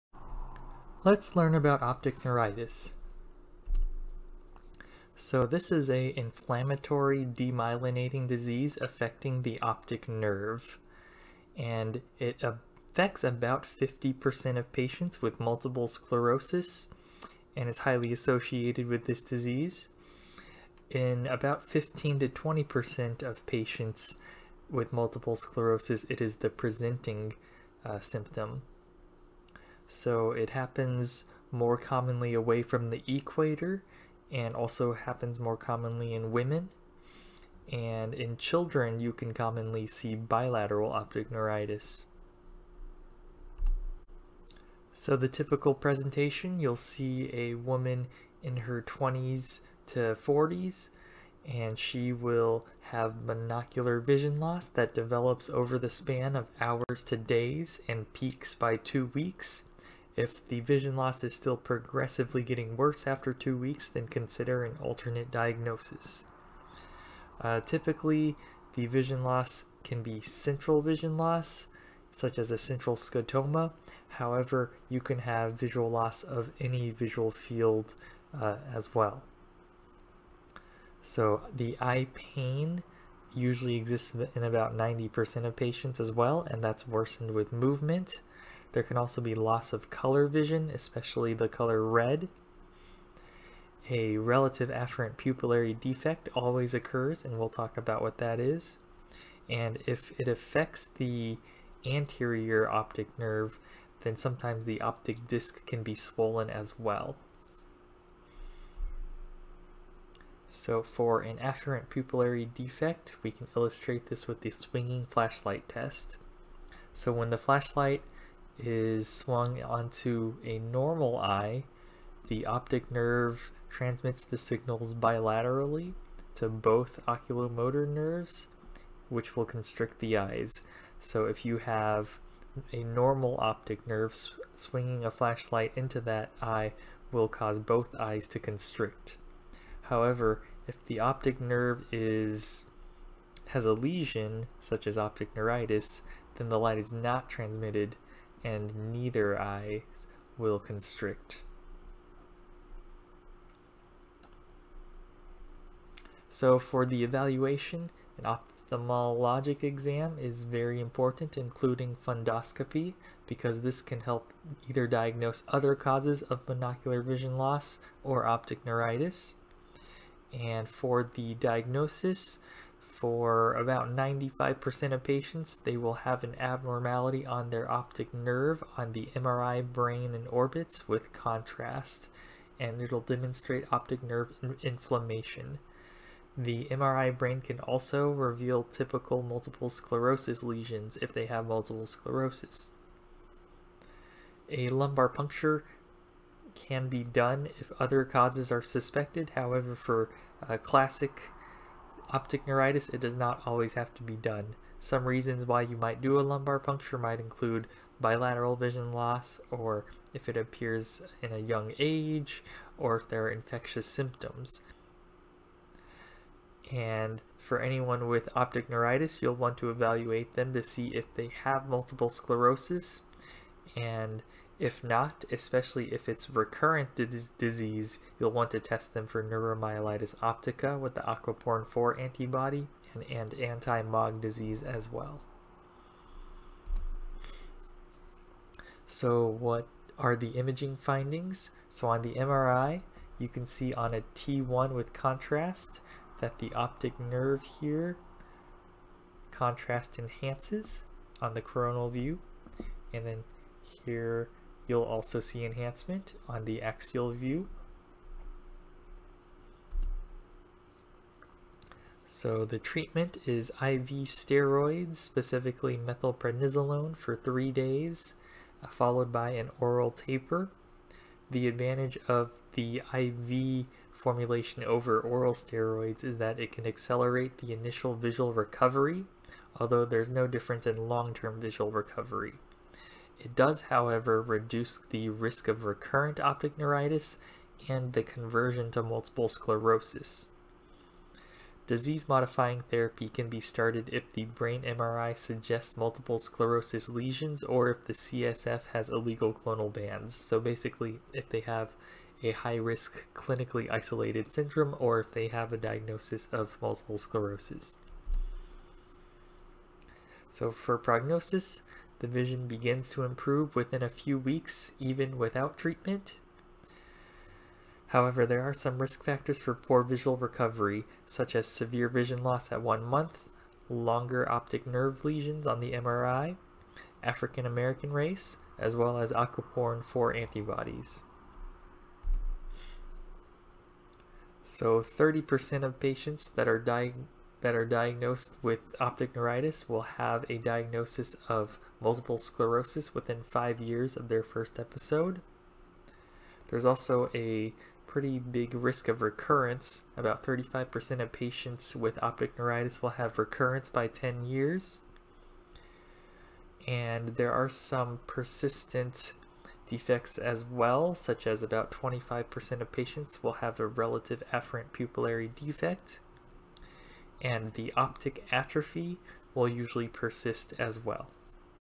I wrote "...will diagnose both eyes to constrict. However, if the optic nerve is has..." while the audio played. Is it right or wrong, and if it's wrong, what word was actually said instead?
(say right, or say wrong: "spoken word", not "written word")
wrong: "cause", not "diagnose".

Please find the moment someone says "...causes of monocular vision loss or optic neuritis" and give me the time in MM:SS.
02:45.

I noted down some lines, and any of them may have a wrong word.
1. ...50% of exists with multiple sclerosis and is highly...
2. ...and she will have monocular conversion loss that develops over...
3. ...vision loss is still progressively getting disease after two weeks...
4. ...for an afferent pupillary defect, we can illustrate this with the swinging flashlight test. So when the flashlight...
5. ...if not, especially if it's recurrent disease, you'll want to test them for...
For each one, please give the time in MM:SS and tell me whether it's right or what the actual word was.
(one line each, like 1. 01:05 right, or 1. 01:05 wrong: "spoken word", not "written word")
1. 00:13 wrong: "patients", not "exists"
2. 00:51 wrong: "vision", not "conversion"
3. 01:00 wrong: "worse", not "disease"
4. 01:50 right
5. 03:44 right.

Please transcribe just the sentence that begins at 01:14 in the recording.
However, you can have visual loss of any visual field uh, as well.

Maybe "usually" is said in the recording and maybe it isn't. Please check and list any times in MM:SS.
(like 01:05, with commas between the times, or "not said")
01:23, 06:09.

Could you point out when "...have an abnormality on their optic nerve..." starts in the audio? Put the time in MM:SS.
02:55.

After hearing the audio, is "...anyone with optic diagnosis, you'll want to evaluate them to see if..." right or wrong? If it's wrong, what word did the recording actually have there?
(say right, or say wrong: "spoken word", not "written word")
wrong: "neuritis", not "diagnosis".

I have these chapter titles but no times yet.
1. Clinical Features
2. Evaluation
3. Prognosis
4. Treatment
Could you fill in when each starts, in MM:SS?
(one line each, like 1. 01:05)
1. 00:43
2. 02:34
3. 05:08
4. 04:20.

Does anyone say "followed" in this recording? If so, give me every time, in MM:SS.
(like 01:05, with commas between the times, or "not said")
04:28.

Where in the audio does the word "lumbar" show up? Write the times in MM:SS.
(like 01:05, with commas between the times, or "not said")
03:14, 03:26.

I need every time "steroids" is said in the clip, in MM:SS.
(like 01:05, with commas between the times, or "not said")
04:24, 04:35.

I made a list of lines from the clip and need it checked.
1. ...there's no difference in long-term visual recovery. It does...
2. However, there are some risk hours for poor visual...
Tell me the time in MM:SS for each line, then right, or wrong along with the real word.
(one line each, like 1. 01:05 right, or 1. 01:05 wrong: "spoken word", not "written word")
1. 04:39 right
2. 05:17 wrong: "factors", not "hours".